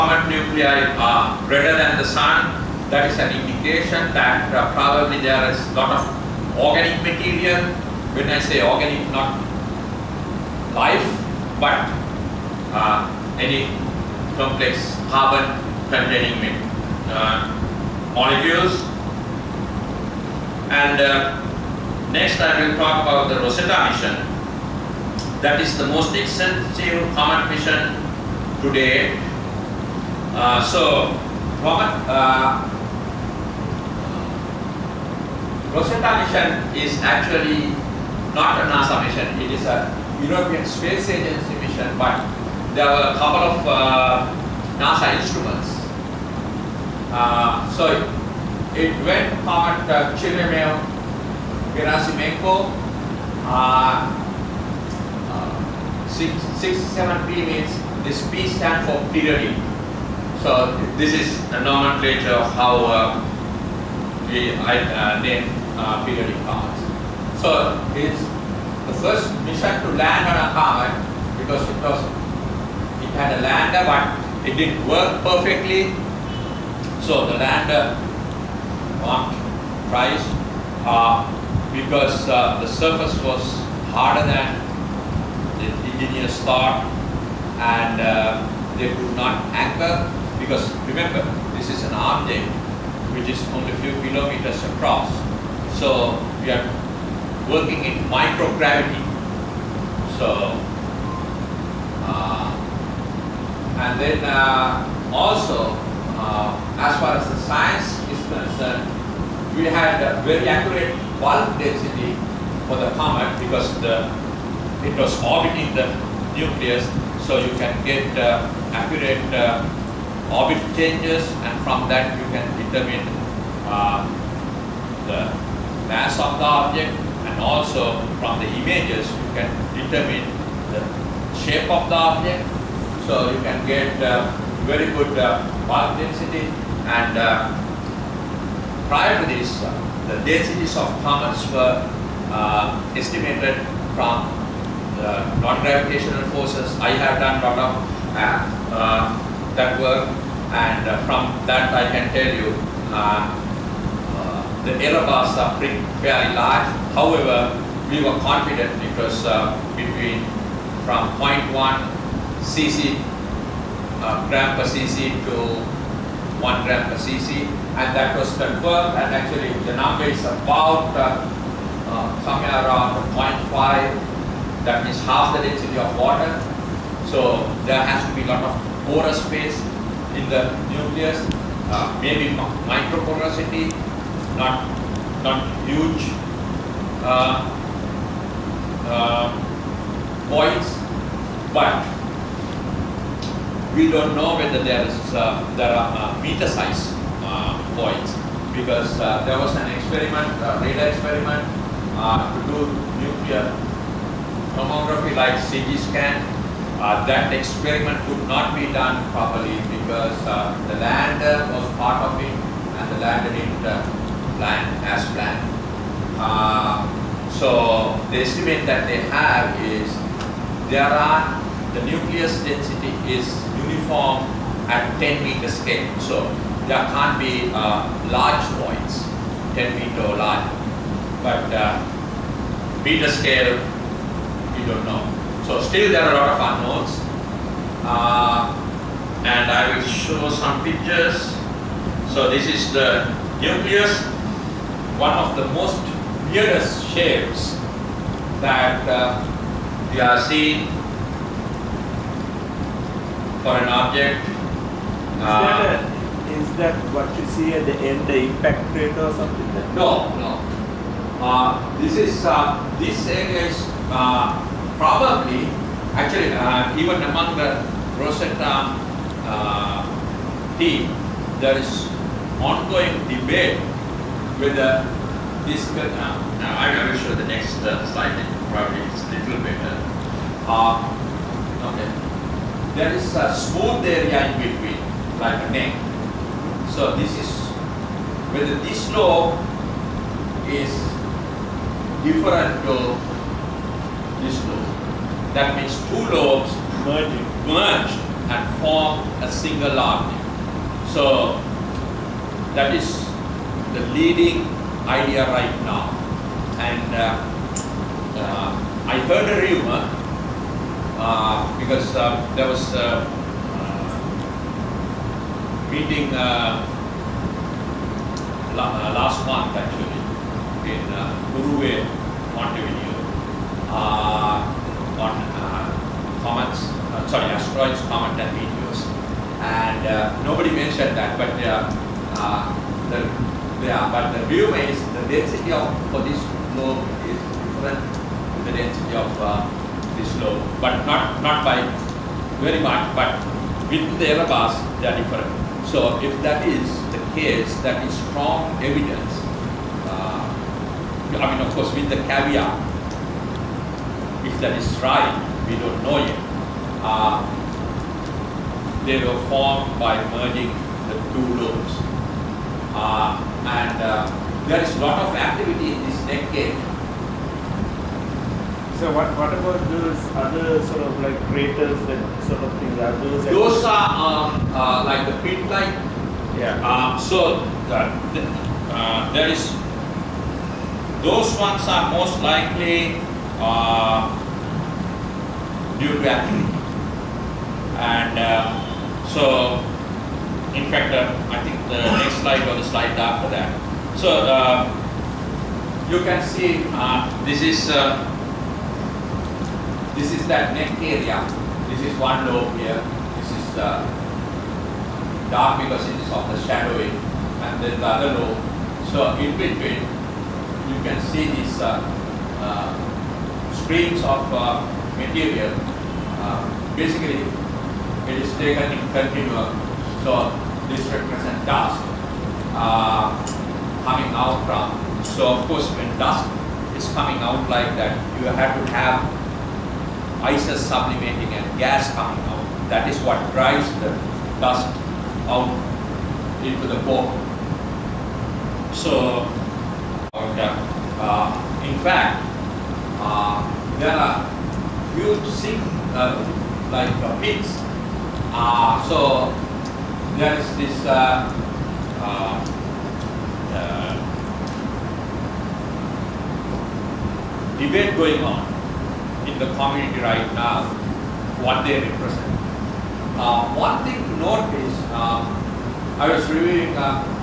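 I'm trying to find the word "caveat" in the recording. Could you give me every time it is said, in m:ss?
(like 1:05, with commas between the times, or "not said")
5:52.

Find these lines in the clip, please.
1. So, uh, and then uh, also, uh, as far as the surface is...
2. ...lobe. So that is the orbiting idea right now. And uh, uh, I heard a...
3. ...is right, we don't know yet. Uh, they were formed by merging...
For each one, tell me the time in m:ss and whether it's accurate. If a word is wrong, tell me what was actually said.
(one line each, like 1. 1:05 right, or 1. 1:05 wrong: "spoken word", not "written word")
1. 1:40 wrong: "science", not "surface"
2. 4:59 wrong: "leading", not "orbiting"
3. 5:54 right.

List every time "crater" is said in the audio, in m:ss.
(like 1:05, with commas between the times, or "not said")
4:18, 6:11.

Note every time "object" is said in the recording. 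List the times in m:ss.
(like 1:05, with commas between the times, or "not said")
1:31, 2:06, 2:11, 4:13.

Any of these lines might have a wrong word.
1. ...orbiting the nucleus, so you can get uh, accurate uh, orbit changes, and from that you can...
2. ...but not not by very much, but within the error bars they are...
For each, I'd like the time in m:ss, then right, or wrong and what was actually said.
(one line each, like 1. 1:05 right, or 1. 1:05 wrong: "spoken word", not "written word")
1. 1:55 right
2. 5:40 right.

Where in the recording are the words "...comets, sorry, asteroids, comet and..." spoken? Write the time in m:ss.
5:26.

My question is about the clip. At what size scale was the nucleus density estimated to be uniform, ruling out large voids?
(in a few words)
10 meters.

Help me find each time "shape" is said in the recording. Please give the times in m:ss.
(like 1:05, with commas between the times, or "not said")
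2:11, 4:06.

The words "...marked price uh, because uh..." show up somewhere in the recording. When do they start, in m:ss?
1:19.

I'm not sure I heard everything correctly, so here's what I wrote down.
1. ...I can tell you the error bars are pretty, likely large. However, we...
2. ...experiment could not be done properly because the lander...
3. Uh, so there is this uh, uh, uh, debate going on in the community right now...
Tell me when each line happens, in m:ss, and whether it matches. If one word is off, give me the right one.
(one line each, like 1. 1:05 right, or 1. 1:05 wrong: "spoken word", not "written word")
1. 2:31 wrong: "fairly", not "likely"
2. 3:27 right
3. 7:28 right.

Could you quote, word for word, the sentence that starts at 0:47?
Uh, so it, it went part uh, Chirimel Gerasimenko, uh, uh, p means this P stands for periodic.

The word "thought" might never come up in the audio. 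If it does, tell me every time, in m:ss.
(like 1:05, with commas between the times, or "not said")
1:26.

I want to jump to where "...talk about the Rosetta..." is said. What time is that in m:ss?
0:22.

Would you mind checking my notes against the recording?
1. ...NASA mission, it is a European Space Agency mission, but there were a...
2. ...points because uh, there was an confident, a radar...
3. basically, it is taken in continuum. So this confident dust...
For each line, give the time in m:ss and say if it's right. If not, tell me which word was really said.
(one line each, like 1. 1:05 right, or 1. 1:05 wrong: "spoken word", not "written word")
1. 0:38 right
2. 3:17 wrong: "experiment", not "confident"
3. 6:56 wrong: "represent", not "confident".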